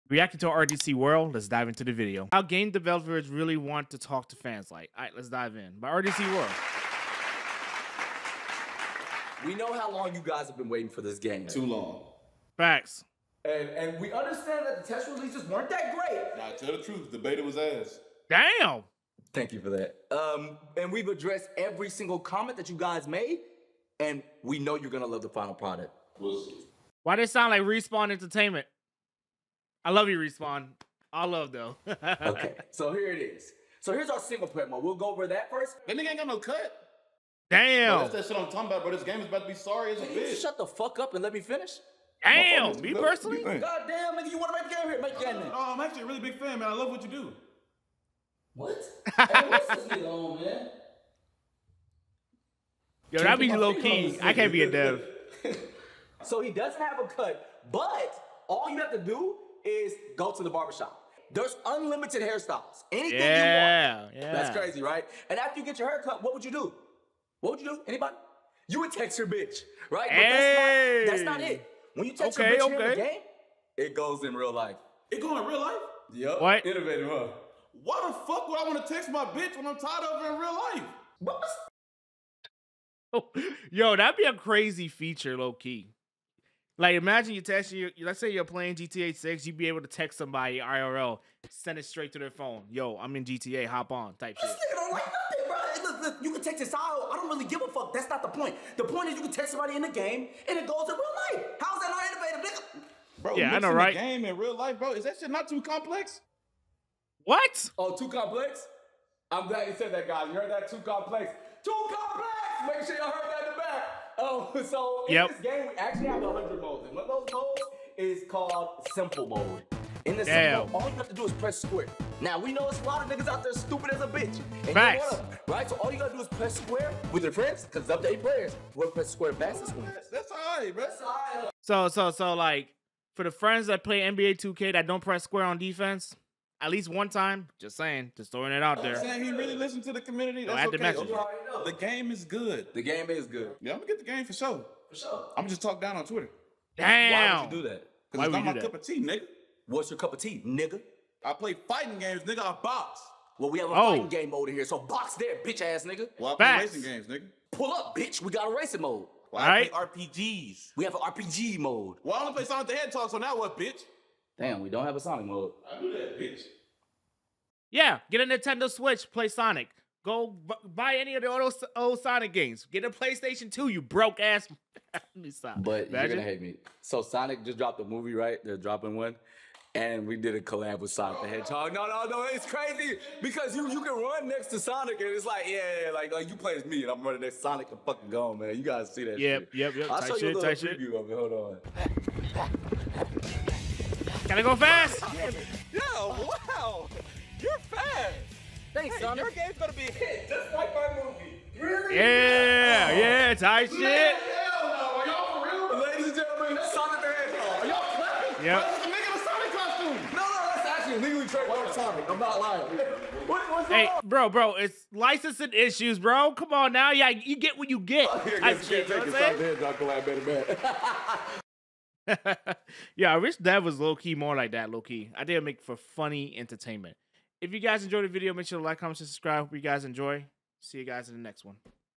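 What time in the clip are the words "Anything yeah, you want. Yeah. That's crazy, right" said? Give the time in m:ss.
1:02.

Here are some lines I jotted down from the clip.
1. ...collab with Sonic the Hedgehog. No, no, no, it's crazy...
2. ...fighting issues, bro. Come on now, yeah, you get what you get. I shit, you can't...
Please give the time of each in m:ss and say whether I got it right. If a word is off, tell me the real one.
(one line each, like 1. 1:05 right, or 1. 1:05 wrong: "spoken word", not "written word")
1. 3:00 right
2. 3:34 wrong: "licensing", not "fighting".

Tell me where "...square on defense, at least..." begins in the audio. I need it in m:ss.
2:15.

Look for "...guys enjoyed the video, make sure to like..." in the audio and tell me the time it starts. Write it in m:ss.
3:47.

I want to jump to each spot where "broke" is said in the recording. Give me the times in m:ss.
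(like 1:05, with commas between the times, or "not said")
2:53.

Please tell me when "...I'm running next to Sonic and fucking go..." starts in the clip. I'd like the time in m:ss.
3:06.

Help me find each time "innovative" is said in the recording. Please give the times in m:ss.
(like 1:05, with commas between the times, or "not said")
1:16, 1:42.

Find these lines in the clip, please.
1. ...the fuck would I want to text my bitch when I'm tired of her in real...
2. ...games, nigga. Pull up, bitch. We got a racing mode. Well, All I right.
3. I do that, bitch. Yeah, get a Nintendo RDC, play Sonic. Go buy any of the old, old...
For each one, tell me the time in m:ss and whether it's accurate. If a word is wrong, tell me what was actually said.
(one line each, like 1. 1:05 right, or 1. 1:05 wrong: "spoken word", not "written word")
1. 1:18 right
2. 2:36 right
3. 2:45 wrong: "Switch", not "RDC".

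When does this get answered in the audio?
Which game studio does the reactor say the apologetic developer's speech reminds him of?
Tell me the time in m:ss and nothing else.
0:27.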